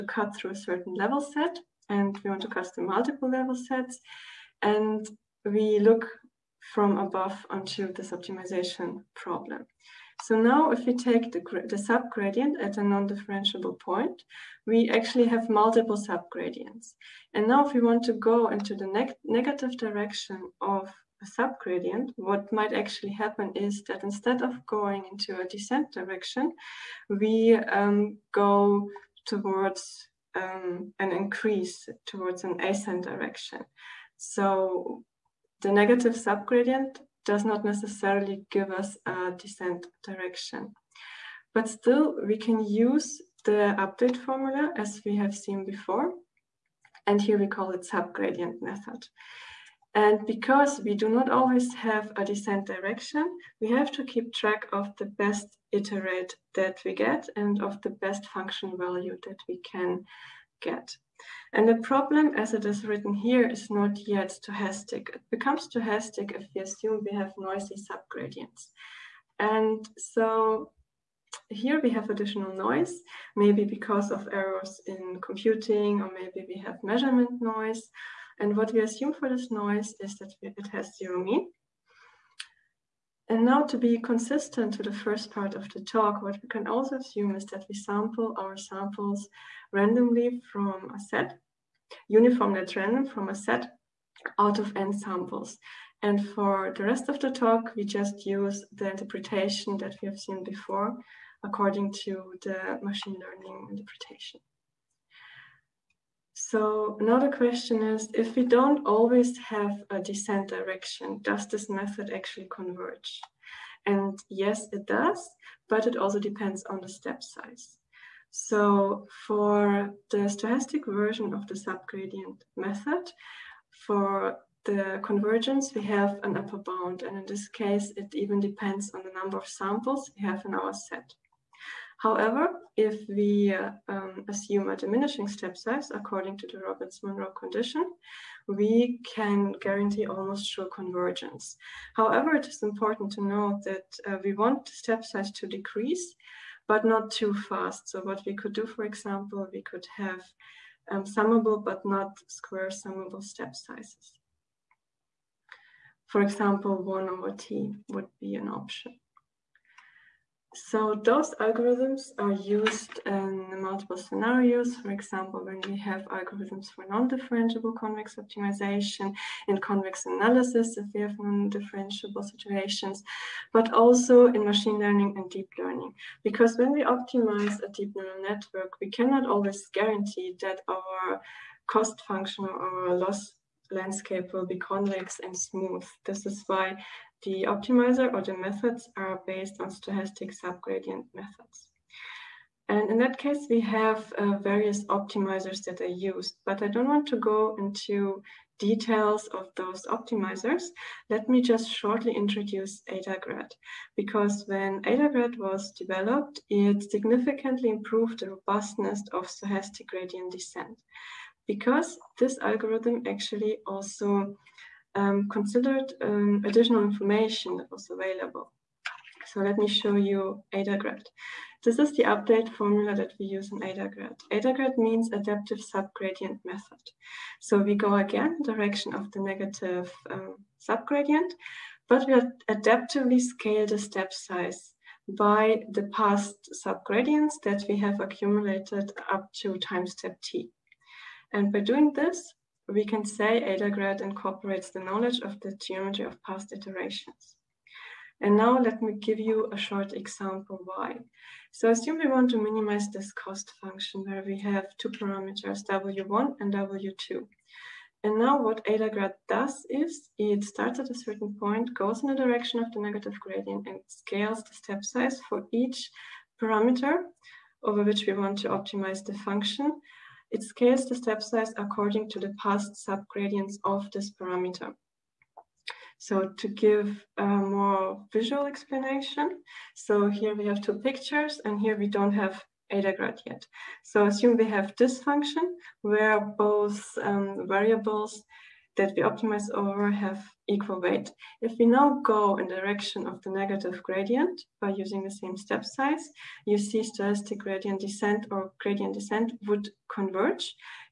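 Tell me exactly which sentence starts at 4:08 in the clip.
And now let me give you a short example why.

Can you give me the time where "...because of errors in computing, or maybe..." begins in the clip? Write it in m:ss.
1:13.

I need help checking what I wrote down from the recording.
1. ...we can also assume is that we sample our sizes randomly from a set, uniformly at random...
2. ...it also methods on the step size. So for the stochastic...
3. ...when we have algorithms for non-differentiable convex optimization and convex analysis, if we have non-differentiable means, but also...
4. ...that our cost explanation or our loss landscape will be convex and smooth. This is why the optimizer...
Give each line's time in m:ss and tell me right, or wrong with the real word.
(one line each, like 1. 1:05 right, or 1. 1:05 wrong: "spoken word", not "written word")
1. 1:26 wrong: "samples", not "sizes"
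2. 1:55 wrong: "depends", not "methods"
3. 2:45 wrong: "situations", not "means"
4. 3:00 wrong: "function", not "explanation".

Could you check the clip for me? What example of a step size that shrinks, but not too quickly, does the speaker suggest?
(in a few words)
1/t.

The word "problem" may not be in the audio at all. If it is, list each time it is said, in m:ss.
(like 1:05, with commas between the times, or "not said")
0:09, 1:01.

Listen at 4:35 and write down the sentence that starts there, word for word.
So to give a more visual explanation, so here we have two pictures and here we don't have AdaGrad yet.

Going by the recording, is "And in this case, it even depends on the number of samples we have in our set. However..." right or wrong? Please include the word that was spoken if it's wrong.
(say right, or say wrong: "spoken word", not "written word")
right.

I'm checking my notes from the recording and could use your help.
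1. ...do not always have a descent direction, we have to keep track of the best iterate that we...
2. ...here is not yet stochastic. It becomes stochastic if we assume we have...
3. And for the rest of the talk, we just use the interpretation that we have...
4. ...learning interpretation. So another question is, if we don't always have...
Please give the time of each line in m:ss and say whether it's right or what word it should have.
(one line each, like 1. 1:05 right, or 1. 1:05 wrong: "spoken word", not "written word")
1. 0:50 right
2. 1:03 right
3. 1:36 right
4. 1:43 right.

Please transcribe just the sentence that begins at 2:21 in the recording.
However, it is important to note that uh, we want the step size to decrease, but not too fast.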